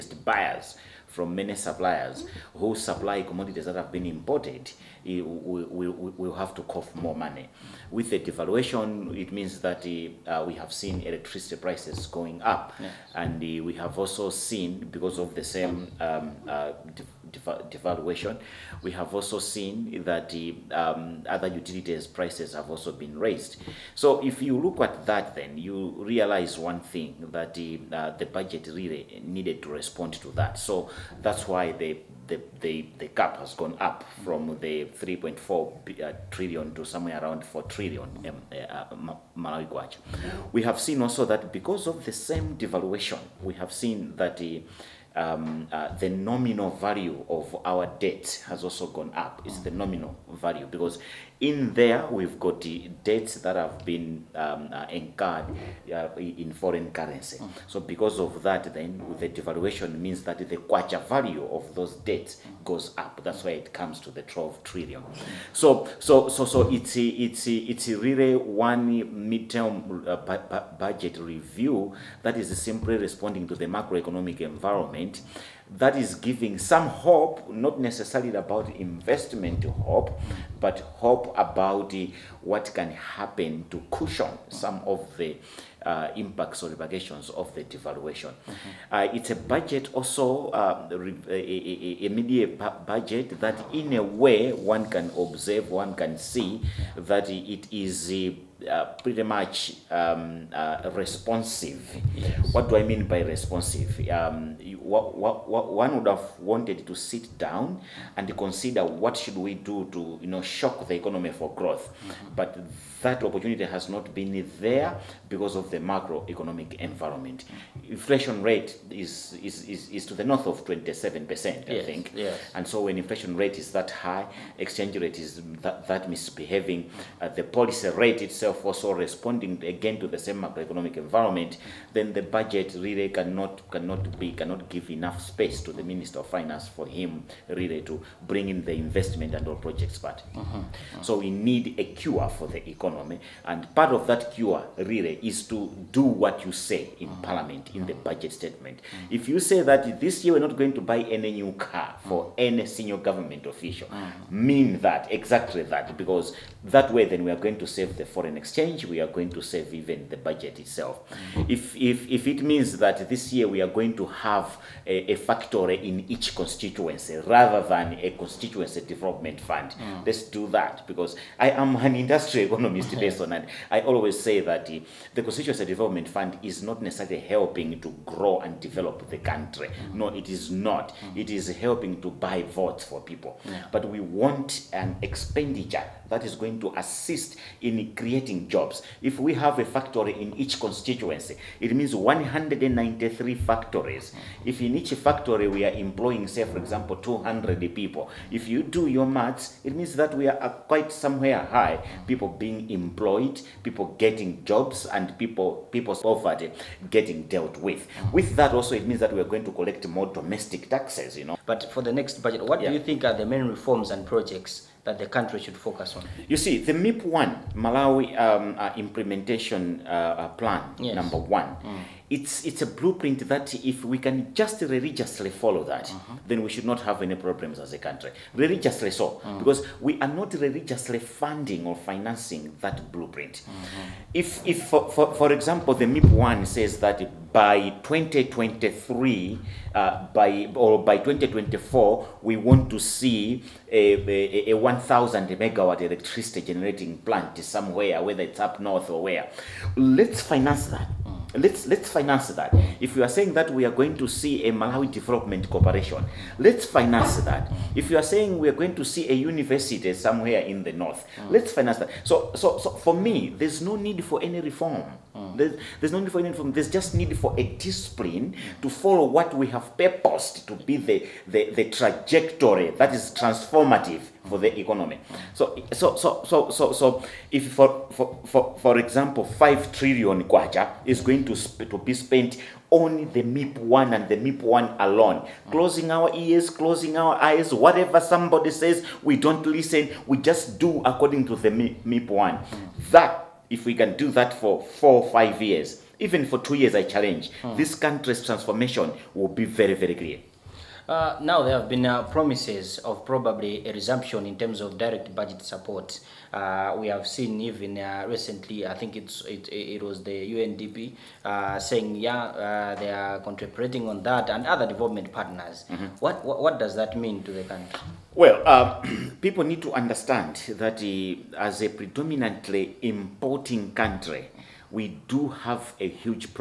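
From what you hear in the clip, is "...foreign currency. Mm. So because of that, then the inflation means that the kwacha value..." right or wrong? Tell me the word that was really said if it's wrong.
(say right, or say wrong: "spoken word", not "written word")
wrong: "devaluation", not "inflation".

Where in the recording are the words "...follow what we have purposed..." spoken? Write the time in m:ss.
4:28.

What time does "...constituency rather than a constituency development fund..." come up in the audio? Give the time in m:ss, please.
2:46.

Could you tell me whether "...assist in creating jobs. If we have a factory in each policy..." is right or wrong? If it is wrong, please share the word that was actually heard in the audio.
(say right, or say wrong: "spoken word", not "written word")
wrong: "constituency", not "policy".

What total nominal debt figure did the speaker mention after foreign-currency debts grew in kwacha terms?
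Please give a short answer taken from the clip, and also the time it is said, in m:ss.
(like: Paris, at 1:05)
12 trillion, at 1:04.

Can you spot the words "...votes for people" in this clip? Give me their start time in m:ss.
3:02.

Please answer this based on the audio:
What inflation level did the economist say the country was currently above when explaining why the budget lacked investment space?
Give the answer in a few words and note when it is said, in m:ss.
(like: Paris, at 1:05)
27 percent, at 2:00.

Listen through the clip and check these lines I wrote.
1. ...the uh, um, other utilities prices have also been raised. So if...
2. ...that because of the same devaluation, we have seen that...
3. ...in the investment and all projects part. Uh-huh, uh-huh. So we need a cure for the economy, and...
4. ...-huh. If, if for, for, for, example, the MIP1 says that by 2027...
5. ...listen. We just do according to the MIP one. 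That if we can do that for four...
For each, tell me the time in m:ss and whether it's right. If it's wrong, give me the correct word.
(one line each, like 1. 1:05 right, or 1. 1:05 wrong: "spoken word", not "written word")
1. 0:20 right
2. 0:41 right
3. 2:18 right
4. 3:53 wrong: "2023", not "2027"
5. 4:49 right.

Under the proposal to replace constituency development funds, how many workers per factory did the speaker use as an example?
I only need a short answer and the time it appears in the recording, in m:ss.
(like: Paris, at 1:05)
200, at 3:16.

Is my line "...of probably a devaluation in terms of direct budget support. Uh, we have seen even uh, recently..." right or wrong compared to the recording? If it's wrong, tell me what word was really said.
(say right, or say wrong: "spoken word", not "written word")
wrong: "resumption", not "devaluation".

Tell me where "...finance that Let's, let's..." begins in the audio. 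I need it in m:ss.
4:10.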